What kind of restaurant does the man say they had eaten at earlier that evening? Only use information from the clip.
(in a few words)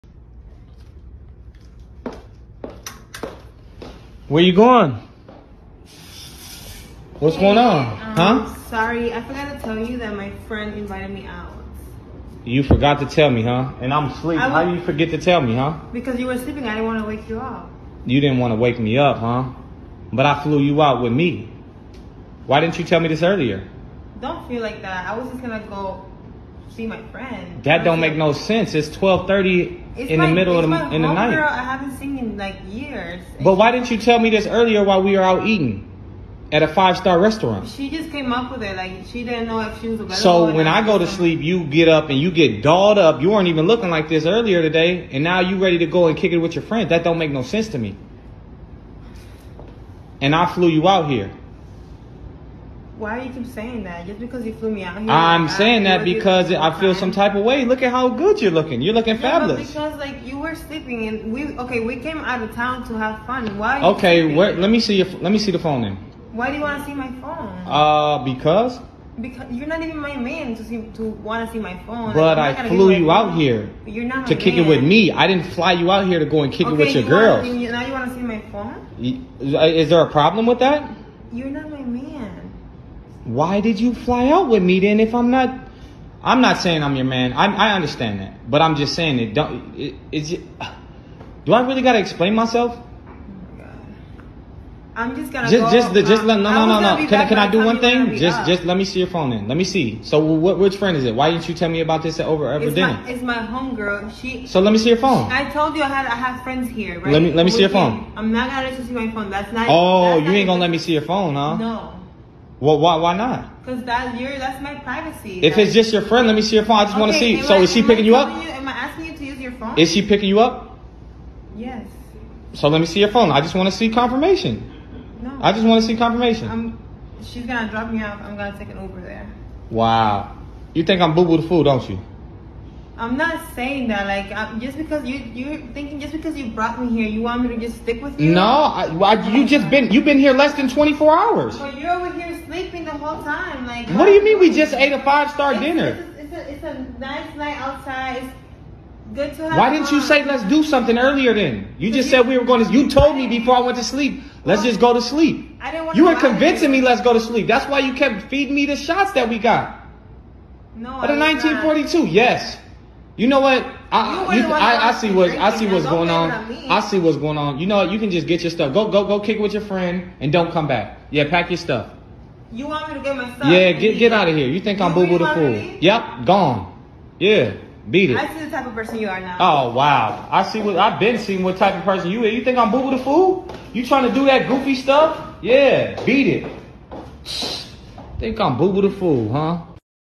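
five star restaurant.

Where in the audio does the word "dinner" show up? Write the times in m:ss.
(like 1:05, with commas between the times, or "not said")
1:42, 2:25.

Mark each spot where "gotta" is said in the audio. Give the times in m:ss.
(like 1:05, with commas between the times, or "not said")
1:31.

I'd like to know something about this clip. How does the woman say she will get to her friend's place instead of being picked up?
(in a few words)
Uber.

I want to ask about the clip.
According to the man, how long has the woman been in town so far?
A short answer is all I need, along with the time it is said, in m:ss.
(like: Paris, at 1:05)
less than 24 hours, at 2:20.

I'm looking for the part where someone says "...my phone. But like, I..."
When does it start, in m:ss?
1:11.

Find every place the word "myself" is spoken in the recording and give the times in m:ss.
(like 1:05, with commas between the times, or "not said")
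1:32.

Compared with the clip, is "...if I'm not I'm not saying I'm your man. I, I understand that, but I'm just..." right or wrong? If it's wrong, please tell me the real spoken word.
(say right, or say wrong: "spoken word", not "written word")
right.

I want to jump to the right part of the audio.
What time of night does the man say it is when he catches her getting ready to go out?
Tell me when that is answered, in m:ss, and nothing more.
0:28.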